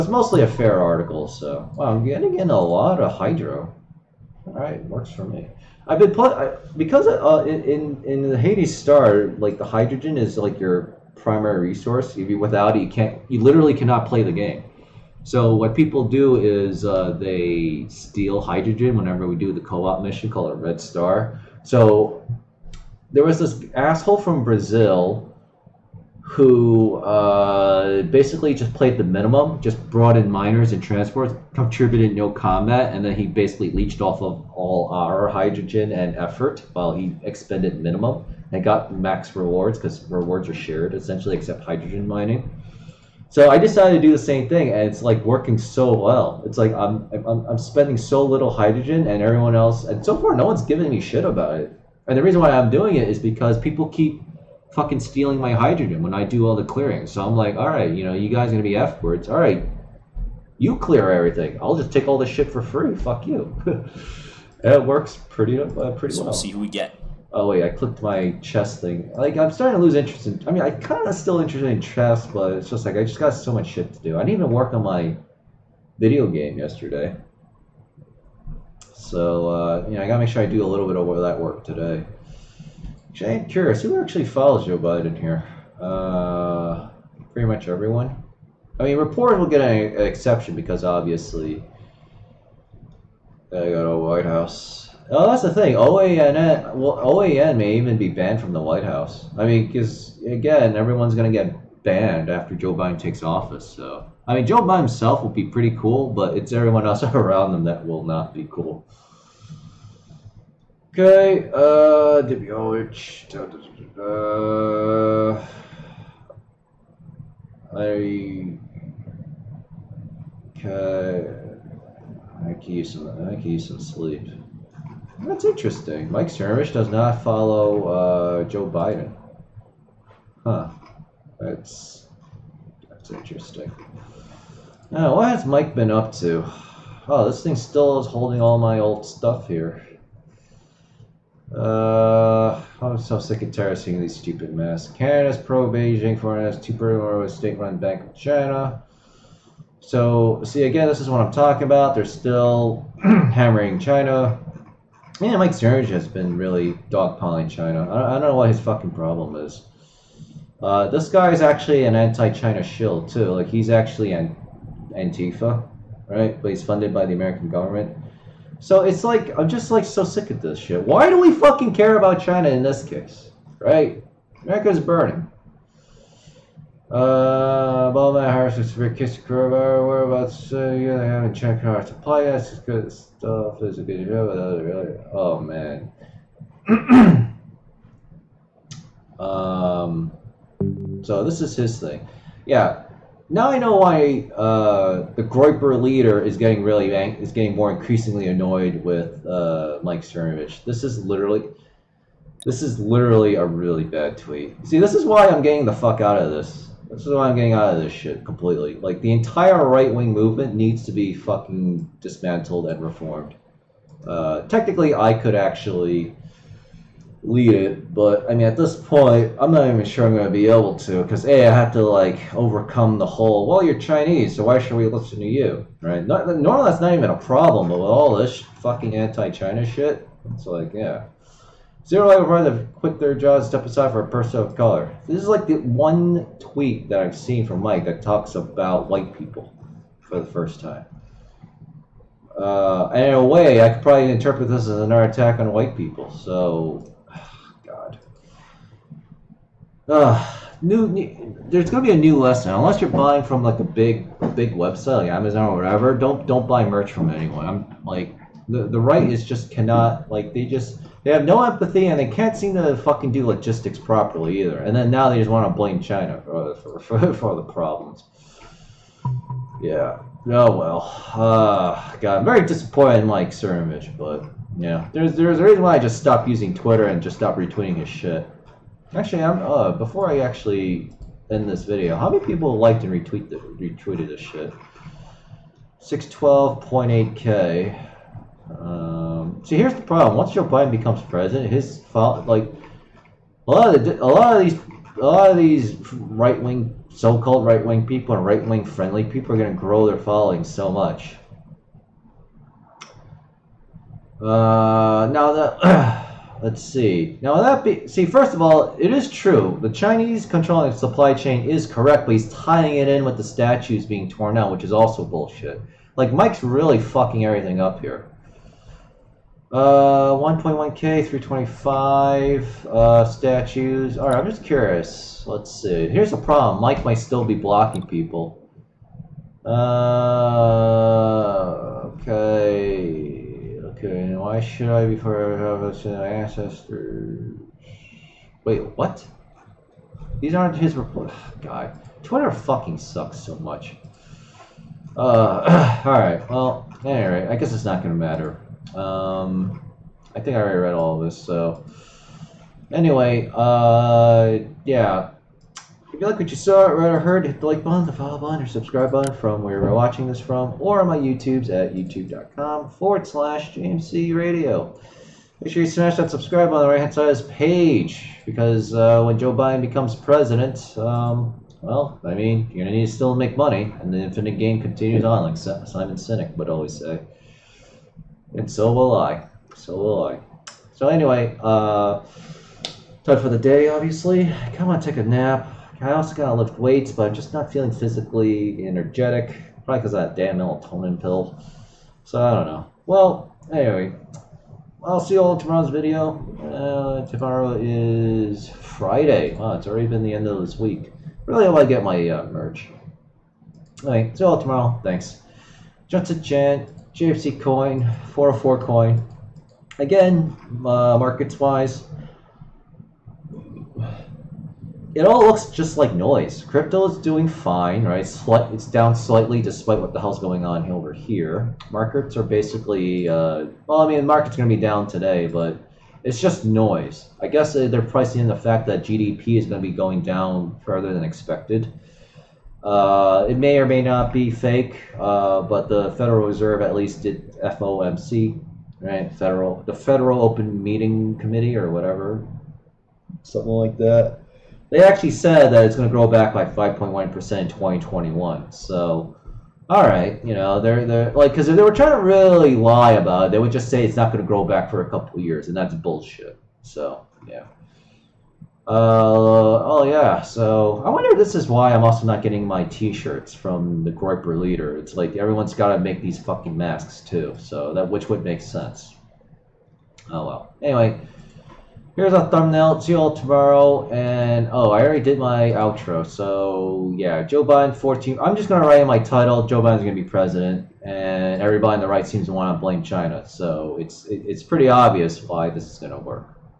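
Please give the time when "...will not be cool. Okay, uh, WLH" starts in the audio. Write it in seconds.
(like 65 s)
107 s.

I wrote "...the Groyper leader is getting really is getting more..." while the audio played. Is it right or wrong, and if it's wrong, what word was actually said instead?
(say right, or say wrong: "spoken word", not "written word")
right.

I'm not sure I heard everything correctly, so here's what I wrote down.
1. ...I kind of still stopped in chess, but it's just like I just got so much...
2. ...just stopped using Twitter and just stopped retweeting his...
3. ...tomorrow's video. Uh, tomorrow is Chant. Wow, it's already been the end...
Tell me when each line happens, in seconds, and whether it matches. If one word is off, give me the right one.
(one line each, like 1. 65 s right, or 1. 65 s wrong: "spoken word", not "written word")
1. 70 s wrong: "interested", not "stopped"
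2. 275 s right
3. 395 s wrong: "Friday", not "Chant".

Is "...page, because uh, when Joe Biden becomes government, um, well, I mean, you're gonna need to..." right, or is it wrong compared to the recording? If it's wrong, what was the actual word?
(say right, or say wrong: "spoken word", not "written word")
wrong: "president", not "government".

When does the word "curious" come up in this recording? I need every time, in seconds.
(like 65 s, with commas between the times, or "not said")
83 s, 324 s.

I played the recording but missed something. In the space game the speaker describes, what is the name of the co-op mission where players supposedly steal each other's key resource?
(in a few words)
Red Star.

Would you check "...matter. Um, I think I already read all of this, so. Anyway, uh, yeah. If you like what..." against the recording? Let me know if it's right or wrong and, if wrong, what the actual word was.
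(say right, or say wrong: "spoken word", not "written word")
right.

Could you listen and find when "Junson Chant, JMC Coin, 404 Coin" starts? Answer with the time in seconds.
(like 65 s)
405 s.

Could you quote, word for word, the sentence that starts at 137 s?
Oh, this thing still is holding all my old stuff here.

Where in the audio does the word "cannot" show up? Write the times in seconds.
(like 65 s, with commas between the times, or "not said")
13 s, 259 s.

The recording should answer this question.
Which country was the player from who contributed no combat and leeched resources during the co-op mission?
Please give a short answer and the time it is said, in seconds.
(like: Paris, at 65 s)
Brazil, at 24 s.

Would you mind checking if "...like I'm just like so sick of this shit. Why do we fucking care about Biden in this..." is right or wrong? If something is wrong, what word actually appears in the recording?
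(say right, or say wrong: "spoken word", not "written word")
wrong: "China", not "Biden".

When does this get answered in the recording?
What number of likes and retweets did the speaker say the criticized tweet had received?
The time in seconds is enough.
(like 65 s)
285 s.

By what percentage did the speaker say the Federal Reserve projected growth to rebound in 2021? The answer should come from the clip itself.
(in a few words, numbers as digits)
5.1 percent.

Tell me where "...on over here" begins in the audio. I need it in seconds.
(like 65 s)
420 s.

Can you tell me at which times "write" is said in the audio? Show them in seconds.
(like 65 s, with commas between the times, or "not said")
478 s.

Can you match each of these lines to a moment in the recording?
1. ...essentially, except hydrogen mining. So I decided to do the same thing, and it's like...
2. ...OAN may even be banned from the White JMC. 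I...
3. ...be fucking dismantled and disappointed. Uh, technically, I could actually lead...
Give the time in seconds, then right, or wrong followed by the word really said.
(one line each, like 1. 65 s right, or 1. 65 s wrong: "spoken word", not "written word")
1. 40 s right
2. 96 s wrong: "House", not "JMC"
3. 210 s wrong: "reformed", not "disappointed".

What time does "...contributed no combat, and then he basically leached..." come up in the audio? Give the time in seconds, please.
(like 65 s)
31 s.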